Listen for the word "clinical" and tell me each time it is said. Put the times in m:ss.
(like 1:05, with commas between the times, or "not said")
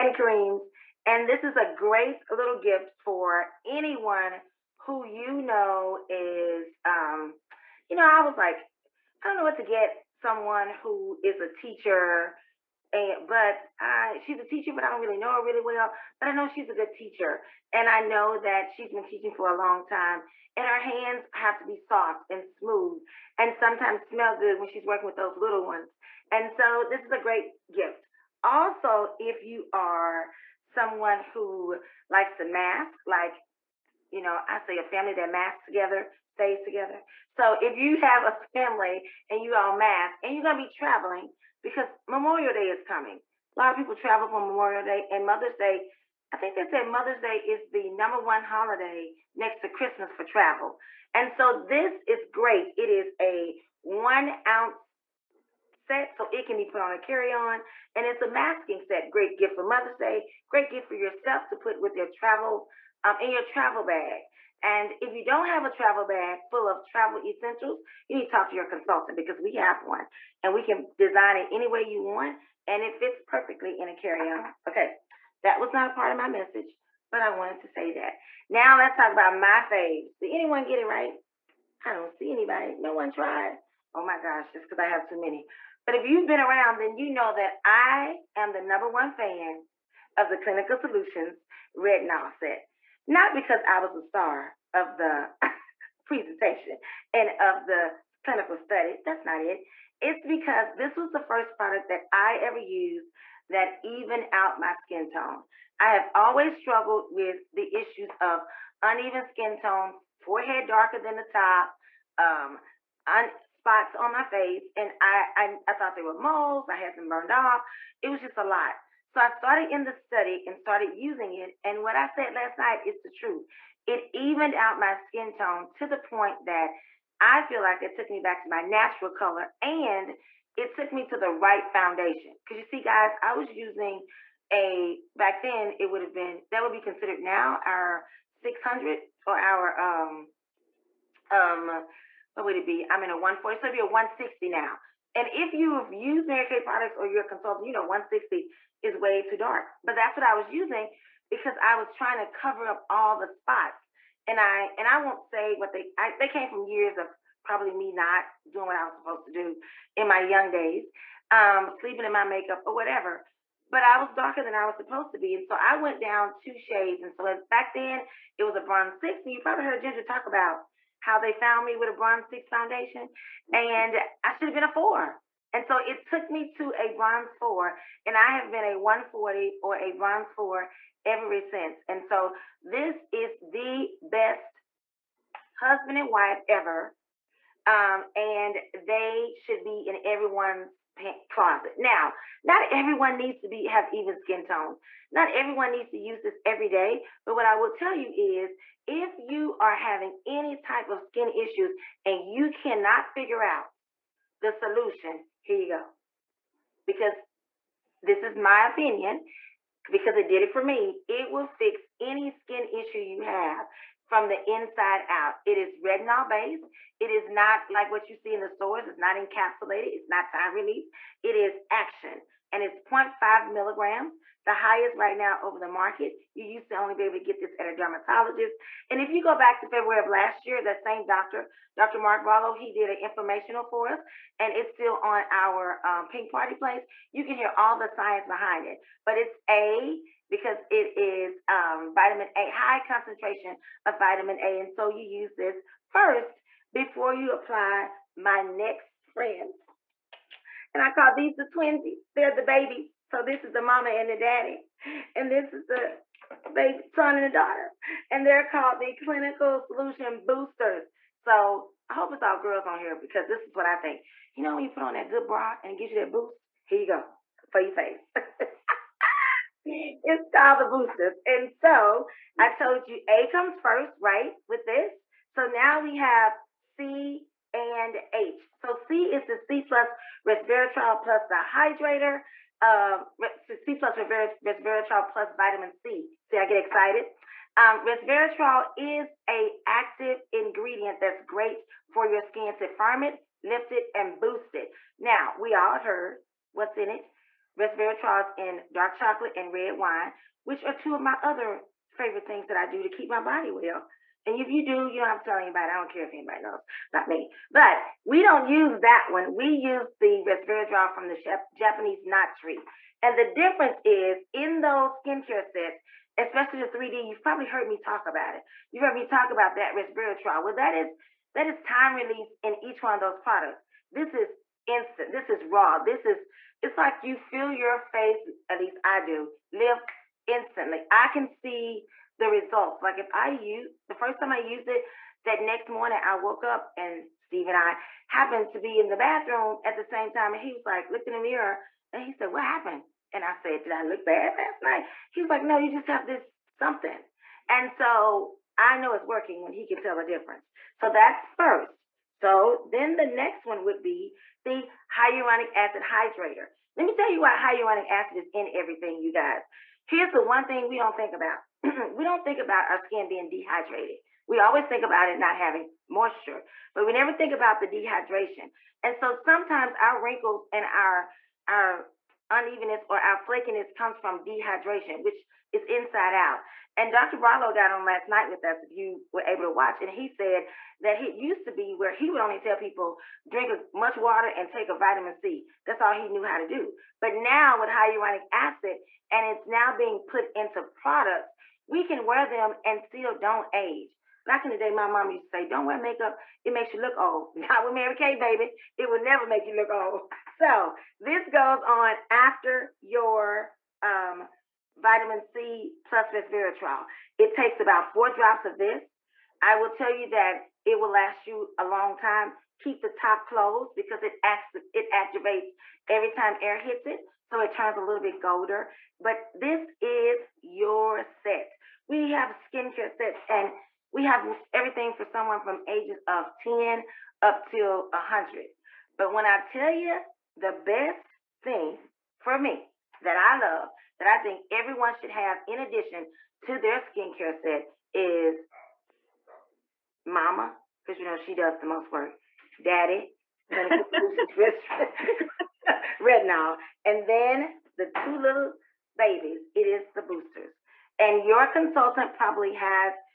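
1:30, 1:38, 4:18.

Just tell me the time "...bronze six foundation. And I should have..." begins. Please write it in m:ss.
2:51.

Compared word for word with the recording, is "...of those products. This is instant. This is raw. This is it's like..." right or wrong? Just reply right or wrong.
right.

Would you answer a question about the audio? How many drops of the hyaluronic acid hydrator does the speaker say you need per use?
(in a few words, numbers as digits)
4.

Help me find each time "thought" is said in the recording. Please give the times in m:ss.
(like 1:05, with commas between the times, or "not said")
1:55.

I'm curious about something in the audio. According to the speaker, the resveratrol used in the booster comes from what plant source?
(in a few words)
Japanese knot tree.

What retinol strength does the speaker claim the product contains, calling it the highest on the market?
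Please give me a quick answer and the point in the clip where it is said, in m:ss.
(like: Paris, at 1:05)
0.5 milligrams, at 3:42.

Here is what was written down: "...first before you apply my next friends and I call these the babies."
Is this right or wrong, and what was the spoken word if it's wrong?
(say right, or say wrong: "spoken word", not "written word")
wrong: "twinsies", not "babies".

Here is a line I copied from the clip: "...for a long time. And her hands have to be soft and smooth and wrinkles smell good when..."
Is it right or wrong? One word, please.
wrong.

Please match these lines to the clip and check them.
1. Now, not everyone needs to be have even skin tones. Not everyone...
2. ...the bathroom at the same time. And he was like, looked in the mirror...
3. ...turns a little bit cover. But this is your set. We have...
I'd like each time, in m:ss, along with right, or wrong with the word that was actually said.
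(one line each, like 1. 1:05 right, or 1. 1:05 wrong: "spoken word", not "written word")
1. 3:11 right
2. 5:38 right
3. 6:57 wrong: "golder", not "cover".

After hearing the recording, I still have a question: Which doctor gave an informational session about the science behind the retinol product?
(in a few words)
Dr. Mark Barlow.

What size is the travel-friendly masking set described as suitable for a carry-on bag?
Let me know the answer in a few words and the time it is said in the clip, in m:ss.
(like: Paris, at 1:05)
1 ounce, at 0:53.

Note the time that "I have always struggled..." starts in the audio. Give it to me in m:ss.
1:45.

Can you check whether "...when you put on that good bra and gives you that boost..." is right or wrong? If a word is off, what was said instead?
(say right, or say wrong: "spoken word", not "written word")
right.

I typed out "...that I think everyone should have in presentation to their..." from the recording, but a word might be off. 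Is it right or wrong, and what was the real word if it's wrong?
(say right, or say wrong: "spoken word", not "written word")
wrong: "addition", not "presentation".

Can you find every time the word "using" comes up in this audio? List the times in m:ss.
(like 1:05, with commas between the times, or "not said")
2:00, 2:13, 2:30.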